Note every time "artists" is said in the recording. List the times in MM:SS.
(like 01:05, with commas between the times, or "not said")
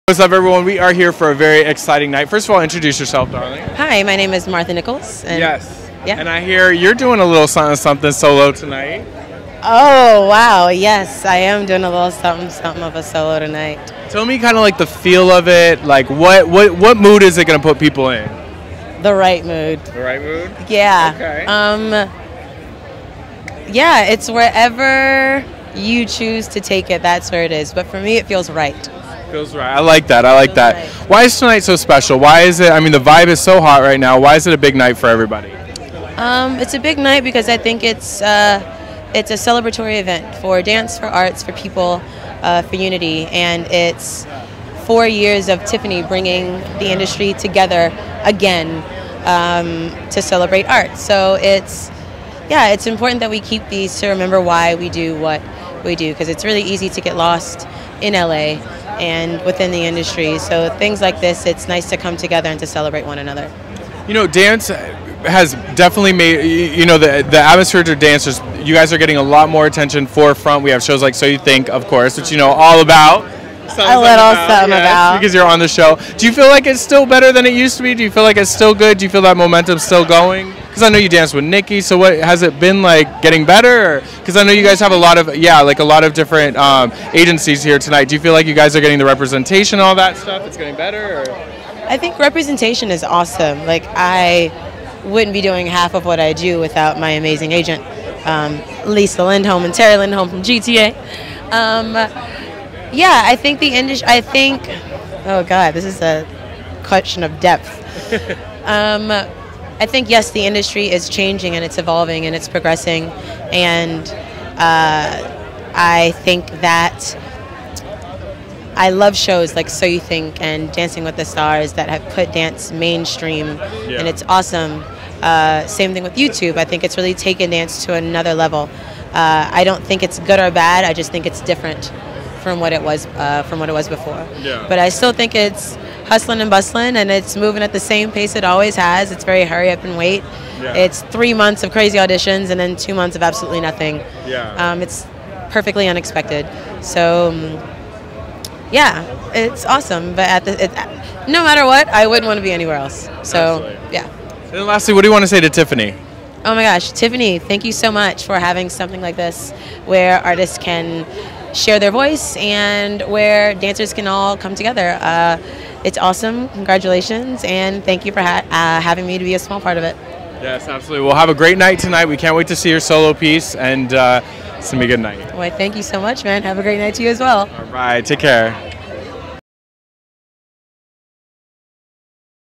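02:40.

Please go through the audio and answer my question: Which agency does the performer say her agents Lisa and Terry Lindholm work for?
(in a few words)
GTA.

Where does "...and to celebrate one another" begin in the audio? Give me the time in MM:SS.
01:02.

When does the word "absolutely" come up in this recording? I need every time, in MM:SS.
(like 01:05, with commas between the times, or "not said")
02:23, 02:33, 02:50.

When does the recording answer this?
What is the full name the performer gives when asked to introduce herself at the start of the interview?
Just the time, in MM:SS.
00:04.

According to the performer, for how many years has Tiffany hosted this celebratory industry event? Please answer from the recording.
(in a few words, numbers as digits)
4.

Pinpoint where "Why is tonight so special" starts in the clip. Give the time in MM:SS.
00:31.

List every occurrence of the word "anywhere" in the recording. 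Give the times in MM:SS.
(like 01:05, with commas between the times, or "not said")
02:32.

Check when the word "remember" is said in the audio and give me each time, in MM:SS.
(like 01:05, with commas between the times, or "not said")
00:54.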